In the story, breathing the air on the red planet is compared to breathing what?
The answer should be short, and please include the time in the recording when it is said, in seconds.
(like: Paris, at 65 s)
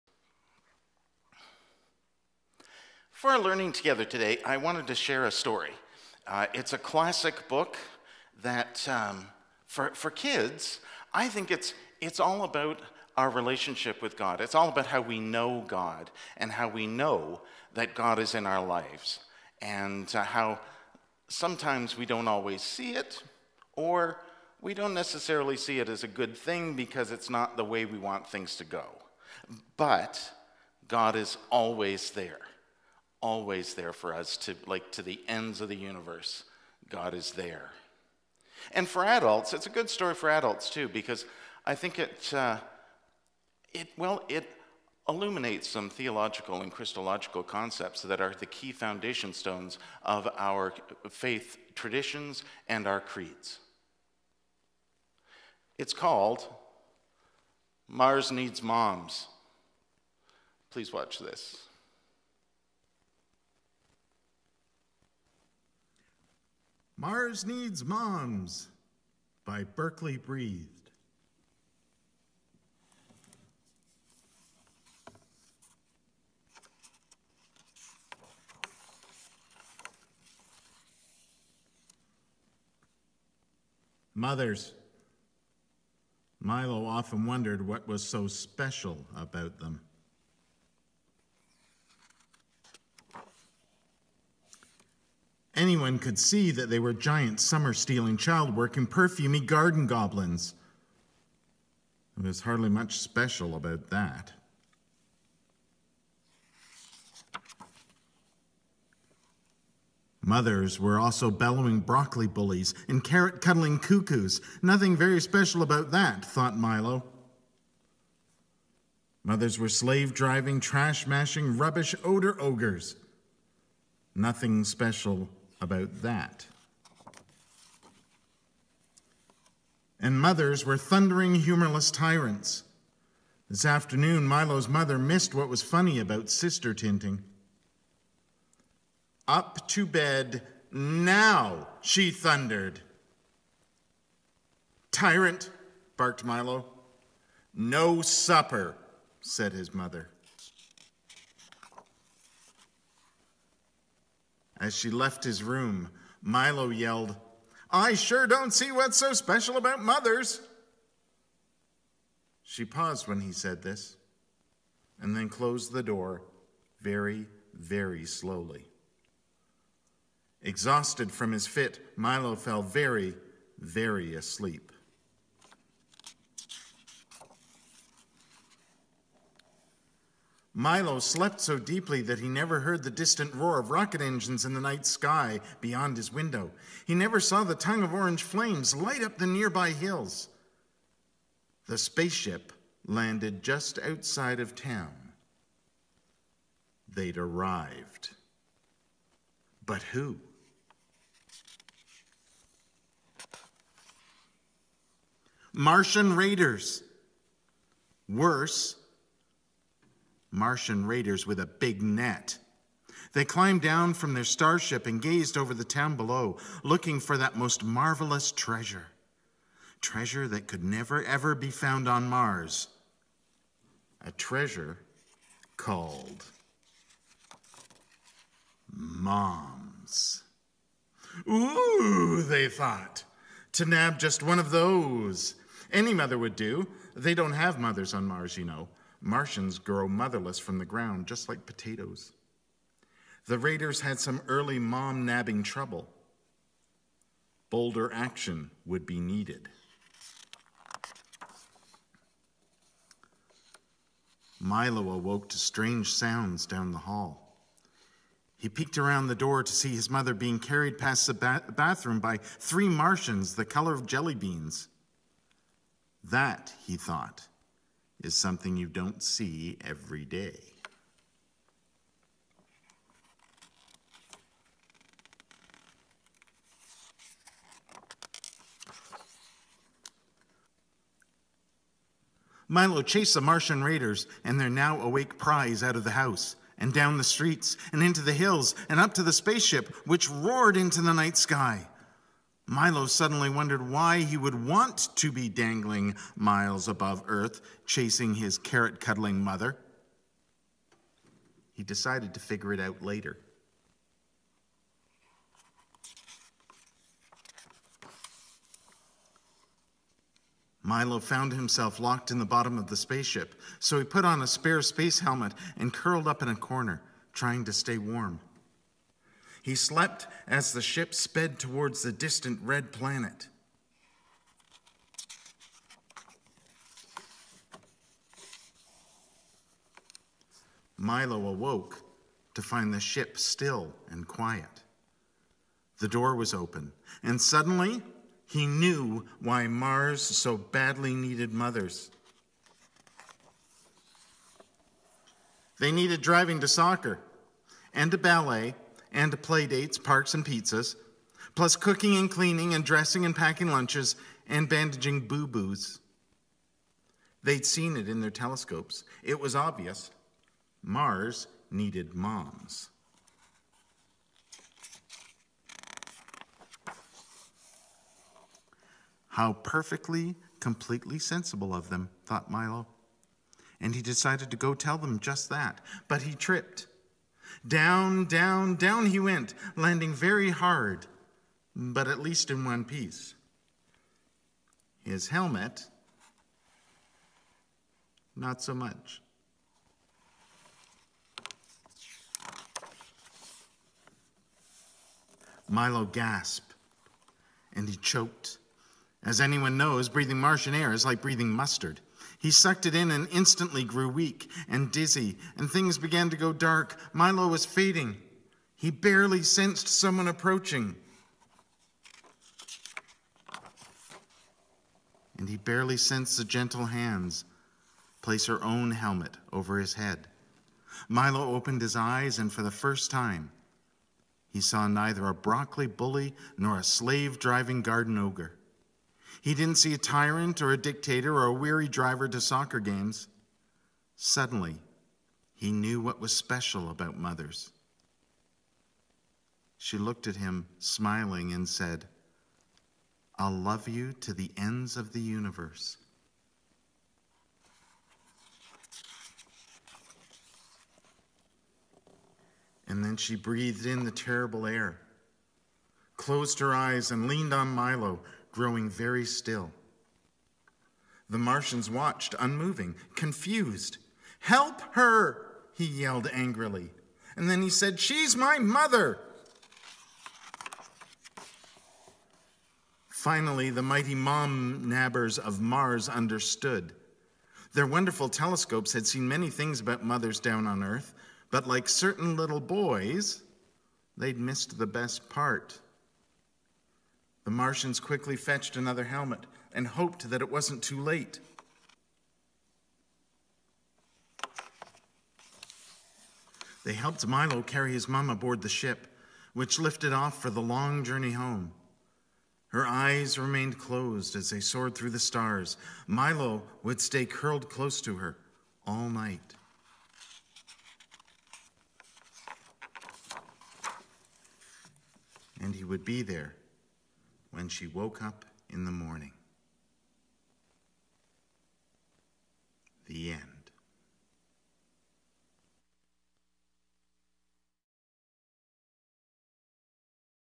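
Mustard, at 401 s.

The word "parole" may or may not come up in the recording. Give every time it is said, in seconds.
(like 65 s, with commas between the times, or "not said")
not said.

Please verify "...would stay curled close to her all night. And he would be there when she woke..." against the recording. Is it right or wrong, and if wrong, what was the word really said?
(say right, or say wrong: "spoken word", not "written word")
right.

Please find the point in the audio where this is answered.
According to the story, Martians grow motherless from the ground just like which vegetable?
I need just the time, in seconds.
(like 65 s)
241 s.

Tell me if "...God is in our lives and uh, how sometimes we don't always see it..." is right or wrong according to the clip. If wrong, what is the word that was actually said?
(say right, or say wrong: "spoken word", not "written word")
right.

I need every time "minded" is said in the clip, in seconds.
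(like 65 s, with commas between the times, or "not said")
not said.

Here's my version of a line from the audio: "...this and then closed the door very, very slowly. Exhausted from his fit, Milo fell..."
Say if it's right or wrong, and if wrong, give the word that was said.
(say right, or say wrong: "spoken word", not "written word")
right.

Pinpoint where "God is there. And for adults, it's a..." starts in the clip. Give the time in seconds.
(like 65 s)
36 s.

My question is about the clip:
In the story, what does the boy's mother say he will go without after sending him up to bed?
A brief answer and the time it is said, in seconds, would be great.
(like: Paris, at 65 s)
Supper, at 148 s.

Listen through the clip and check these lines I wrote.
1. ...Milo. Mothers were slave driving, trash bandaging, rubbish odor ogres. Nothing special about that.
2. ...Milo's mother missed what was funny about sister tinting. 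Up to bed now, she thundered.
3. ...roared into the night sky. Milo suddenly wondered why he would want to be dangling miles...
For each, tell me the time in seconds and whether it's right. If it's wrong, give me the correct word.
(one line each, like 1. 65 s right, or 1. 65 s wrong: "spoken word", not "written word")
1. 116 s wrong: "mashing", not "bandaging"
2. 134 s right
3. 290 s right.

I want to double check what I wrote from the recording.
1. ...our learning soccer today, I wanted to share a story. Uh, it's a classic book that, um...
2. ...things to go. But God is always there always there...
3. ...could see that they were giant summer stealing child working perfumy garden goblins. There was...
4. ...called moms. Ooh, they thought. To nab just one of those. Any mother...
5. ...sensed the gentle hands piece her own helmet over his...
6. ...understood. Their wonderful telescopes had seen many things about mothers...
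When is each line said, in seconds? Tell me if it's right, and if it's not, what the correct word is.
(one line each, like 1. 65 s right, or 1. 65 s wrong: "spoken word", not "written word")
1. 3 s wrong: "together", not "soccer"
2. 28 s right
3. 95 s right
4. 225 s right
5. 415 s wrong: "place", not "piece"
6. 475 s right.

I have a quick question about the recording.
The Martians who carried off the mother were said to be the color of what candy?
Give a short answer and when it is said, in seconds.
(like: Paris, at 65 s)
Jelly beans, at 263 s.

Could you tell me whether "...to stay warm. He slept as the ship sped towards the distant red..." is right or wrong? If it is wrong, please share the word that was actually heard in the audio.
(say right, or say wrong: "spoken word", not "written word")
right.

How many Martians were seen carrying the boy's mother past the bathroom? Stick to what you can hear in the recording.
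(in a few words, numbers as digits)
3.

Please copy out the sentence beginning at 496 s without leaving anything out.
They helped Milo carry his mom aboard the ship, which lifted off for the long journey home.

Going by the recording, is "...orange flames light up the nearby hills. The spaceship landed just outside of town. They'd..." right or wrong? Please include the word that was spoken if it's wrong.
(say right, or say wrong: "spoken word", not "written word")
right.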